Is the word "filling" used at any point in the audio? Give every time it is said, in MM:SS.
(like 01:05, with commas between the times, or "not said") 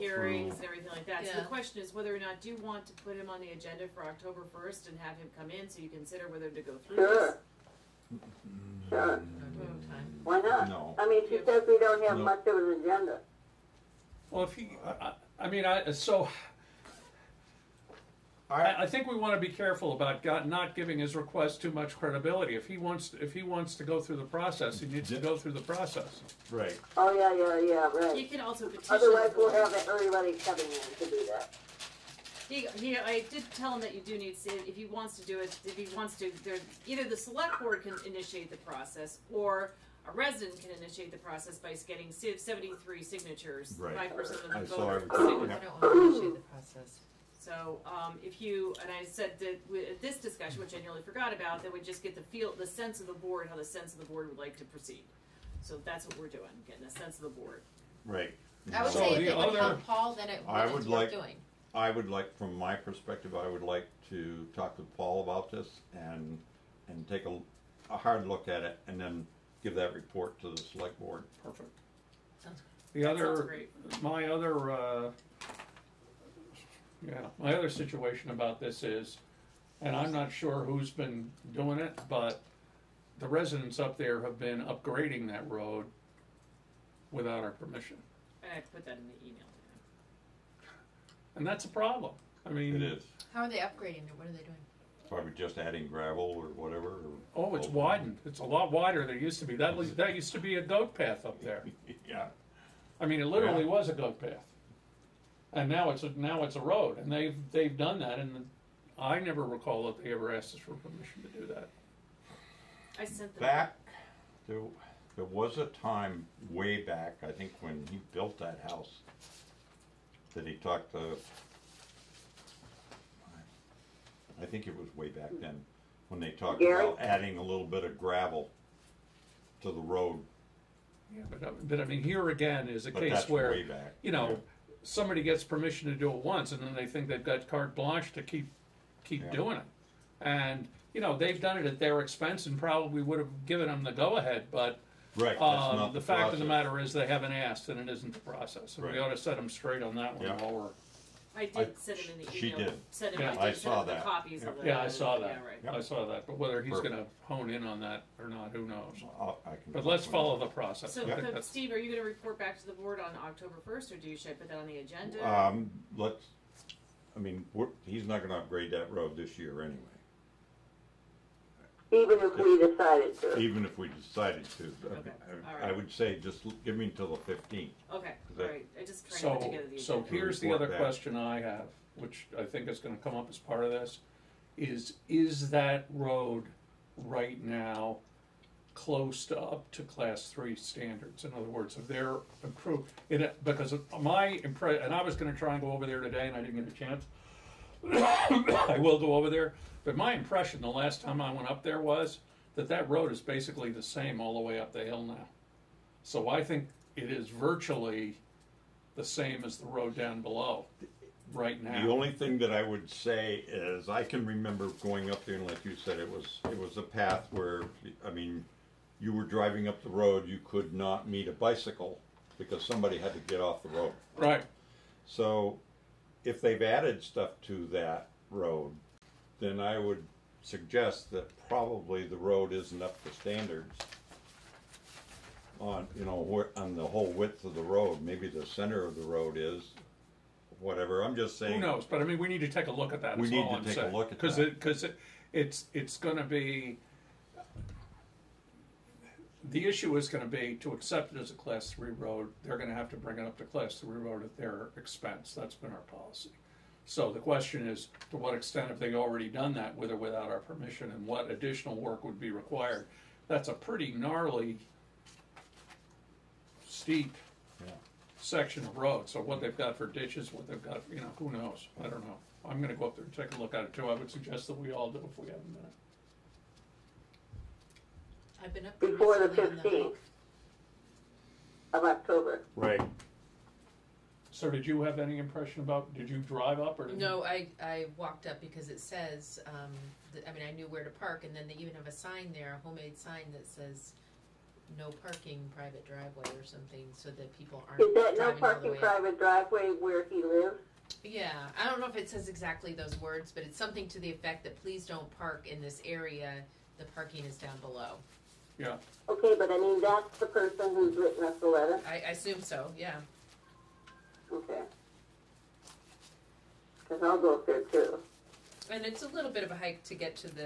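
not said.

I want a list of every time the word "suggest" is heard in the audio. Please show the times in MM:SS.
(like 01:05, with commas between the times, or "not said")
03:50, 04:34.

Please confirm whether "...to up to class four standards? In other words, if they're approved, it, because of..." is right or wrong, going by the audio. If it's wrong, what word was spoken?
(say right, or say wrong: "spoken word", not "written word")
wrong: "three", not "four".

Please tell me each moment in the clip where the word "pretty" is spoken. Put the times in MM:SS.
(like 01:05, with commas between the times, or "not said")
04:23.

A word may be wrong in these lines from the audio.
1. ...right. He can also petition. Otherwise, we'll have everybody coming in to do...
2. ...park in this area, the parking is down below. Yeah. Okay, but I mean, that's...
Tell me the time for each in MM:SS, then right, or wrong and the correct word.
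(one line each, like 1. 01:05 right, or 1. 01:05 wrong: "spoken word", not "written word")
1. 00:28 right
2. 05:05 right.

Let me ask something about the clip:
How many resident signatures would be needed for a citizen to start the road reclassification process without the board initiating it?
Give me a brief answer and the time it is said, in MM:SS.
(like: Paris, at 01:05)
73, at 00:42.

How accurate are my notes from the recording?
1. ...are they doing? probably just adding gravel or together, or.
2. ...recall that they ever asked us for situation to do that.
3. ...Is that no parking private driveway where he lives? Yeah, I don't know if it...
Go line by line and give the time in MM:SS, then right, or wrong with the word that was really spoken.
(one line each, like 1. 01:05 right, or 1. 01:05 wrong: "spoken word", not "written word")
1. 01:34 wrong: "whatever", not "together"
2. 01:49 wrong: "permission", not "situation"
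3. 04:57 right.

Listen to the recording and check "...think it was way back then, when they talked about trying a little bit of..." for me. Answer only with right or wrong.
wrong.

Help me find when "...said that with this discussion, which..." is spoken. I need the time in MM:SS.
00:49.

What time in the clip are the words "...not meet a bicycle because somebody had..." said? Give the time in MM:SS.
03:40.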